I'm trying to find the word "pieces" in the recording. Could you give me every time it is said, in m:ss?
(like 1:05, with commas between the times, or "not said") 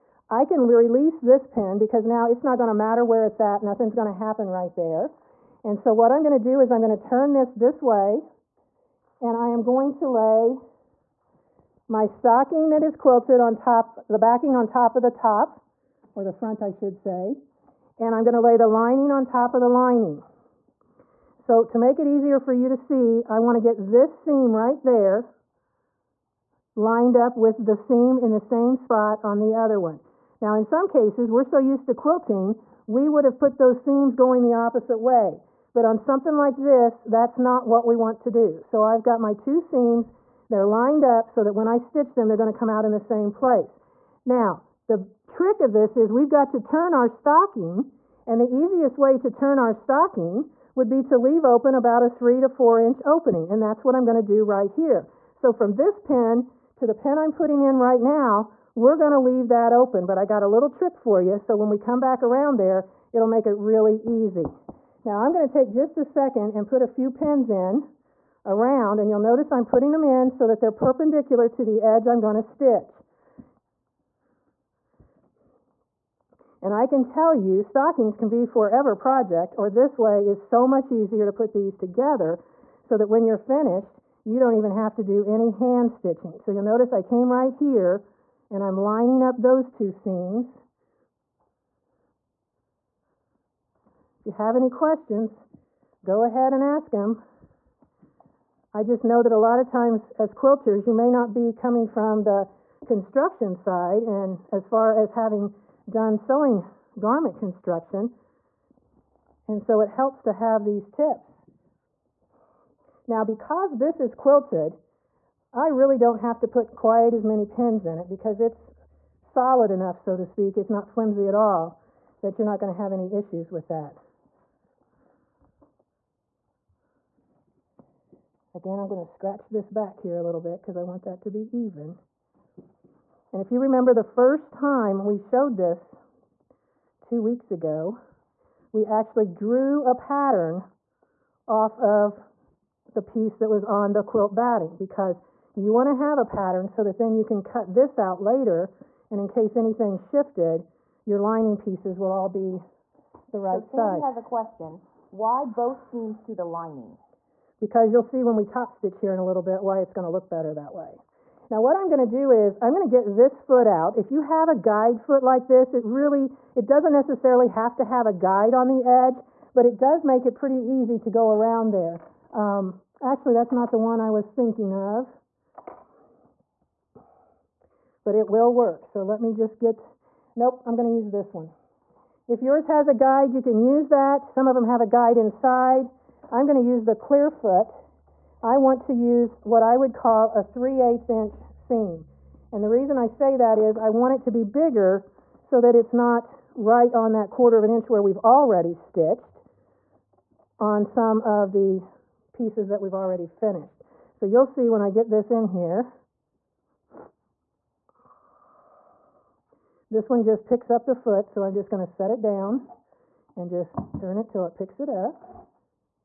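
2:22, 2:31, 3:22.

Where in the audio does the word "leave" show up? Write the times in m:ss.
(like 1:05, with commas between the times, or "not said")
0:51, 0:59.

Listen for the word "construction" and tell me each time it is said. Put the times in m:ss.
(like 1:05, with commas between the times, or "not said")
1:42, 1:47.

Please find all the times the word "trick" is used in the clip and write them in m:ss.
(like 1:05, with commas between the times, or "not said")
0:45, 1:00.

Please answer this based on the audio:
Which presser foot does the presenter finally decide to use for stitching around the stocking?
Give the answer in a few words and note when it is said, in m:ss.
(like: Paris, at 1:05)
Clearfoot, at 3:06.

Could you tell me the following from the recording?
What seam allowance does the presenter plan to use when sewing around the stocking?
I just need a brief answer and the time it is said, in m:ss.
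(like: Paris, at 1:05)
3/8 inch, at 3:10.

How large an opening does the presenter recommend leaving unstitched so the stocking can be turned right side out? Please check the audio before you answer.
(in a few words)
3 to 4 inches.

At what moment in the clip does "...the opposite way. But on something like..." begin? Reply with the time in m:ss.
0:34.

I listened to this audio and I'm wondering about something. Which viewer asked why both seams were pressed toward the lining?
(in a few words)
Sandy.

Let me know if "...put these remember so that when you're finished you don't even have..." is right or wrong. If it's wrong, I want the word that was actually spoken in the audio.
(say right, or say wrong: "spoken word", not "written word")
wrong: "together", not "remember".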